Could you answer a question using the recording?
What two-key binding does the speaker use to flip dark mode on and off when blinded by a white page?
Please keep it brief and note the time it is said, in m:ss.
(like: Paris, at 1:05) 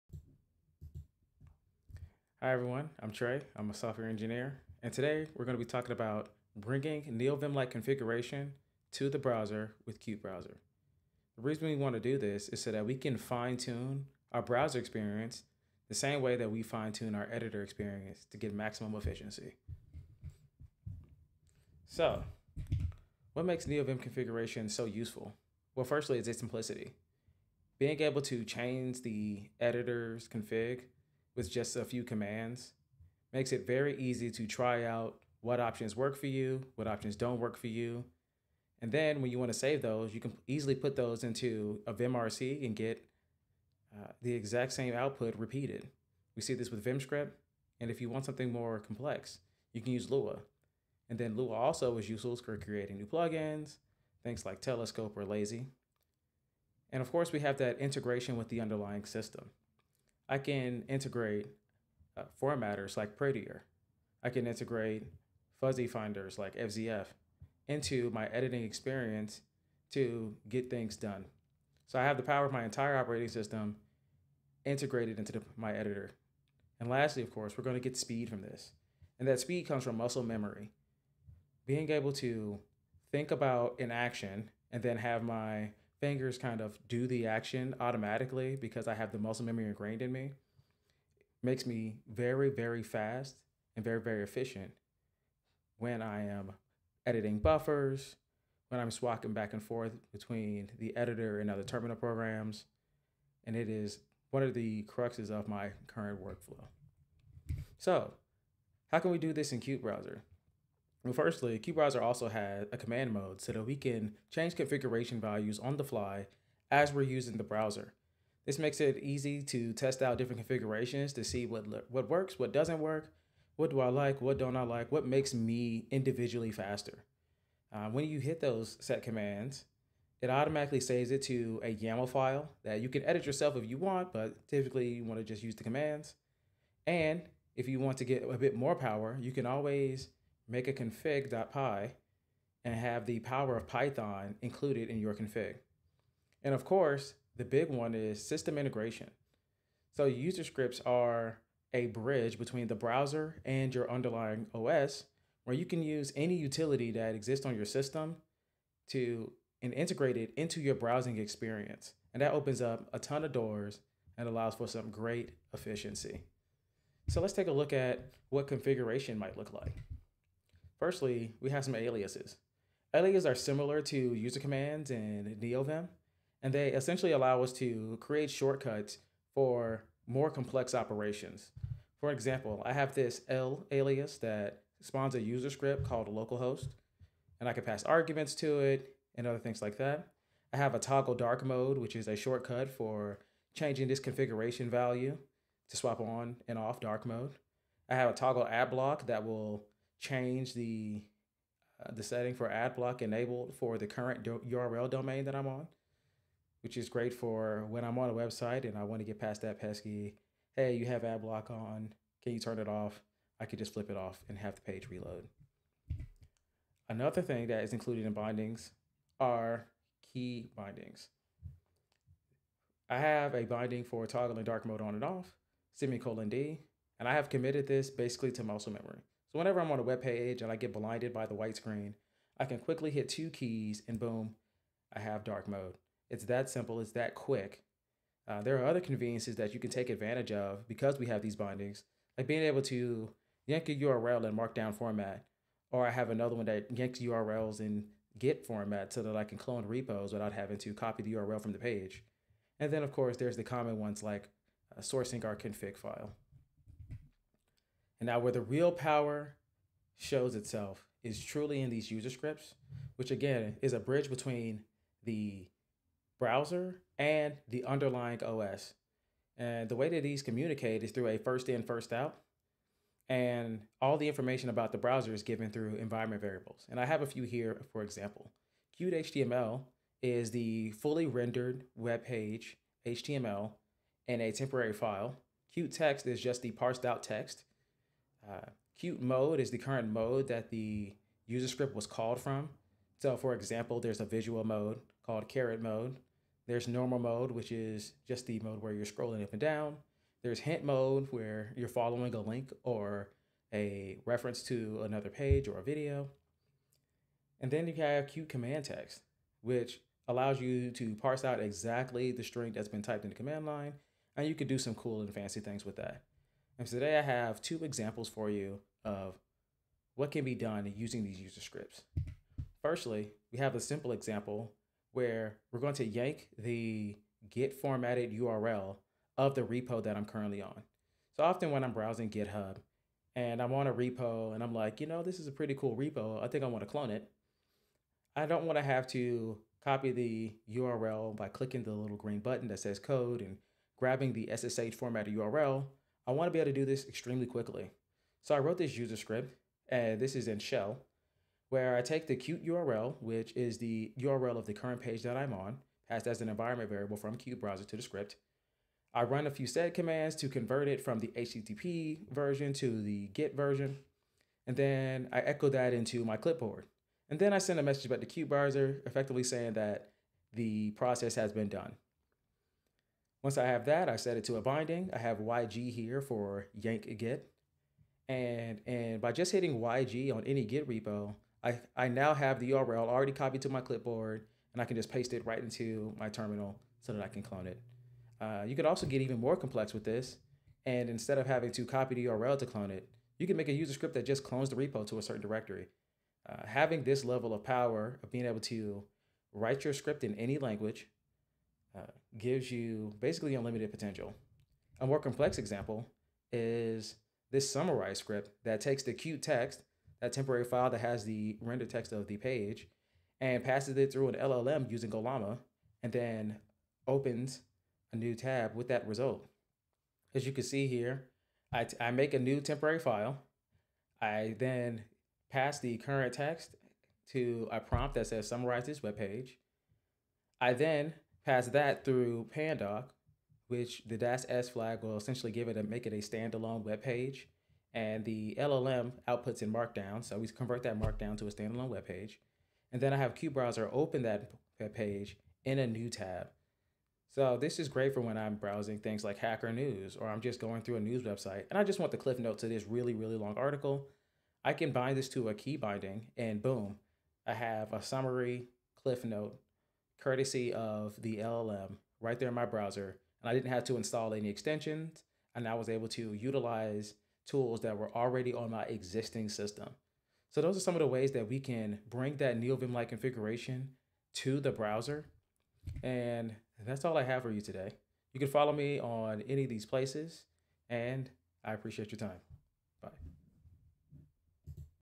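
semicolon D, at 3:45.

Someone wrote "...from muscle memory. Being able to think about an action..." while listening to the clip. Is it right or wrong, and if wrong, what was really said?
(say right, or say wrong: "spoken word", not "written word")
right.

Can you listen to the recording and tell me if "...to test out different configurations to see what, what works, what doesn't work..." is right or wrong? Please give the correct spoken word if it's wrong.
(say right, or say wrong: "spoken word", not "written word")
right.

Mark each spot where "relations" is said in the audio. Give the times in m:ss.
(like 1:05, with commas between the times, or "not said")
not said.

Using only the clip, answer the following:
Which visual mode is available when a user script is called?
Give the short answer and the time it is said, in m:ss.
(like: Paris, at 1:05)
caret mode, at 4:55.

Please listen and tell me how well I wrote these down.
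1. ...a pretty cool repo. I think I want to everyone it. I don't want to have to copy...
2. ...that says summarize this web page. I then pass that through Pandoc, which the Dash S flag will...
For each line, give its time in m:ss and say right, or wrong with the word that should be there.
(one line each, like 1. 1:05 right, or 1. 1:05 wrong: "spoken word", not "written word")
1. 5:35 wrong: "clone", not "everyone"
2. 7:07 right.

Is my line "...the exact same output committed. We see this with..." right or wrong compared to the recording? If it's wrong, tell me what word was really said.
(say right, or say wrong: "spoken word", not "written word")
wrong: "repeated", not "committed".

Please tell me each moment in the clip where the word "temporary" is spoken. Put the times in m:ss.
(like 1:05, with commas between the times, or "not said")
4:44, 6:50, 7:02.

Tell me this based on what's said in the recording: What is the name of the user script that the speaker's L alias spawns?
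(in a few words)
localhost.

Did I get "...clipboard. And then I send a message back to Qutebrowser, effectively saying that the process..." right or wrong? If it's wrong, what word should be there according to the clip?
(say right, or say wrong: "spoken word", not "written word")
right.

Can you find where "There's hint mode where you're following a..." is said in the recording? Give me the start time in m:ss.
5:00.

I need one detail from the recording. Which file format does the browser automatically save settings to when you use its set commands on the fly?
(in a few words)
YAML.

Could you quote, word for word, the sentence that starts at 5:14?
And you could do some cool and fancy things with that.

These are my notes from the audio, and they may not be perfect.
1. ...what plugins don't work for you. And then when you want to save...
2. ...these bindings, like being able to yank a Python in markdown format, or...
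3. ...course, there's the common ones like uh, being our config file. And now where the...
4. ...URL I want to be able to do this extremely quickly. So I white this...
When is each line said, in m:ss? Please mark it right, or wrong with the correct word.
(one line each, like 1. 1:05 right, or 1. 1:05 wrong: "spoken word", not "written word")
1. 0:36 wrong: "options", not "plugins"
2. 4:01 wrong: "URL", not "Python"
3. 4:12 wrong: "sourcing", not "being"
4. 5:45 wrong: "wrote", not "white".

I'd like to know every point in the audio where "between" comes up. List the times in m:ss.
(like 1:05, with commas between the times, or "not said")
1:40, 2:32, 4:24.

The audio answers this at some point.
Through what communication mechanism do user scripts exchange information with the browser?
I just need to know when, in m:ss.
4:31.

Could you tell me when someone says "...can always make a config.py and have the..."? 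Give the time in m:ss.
2:19.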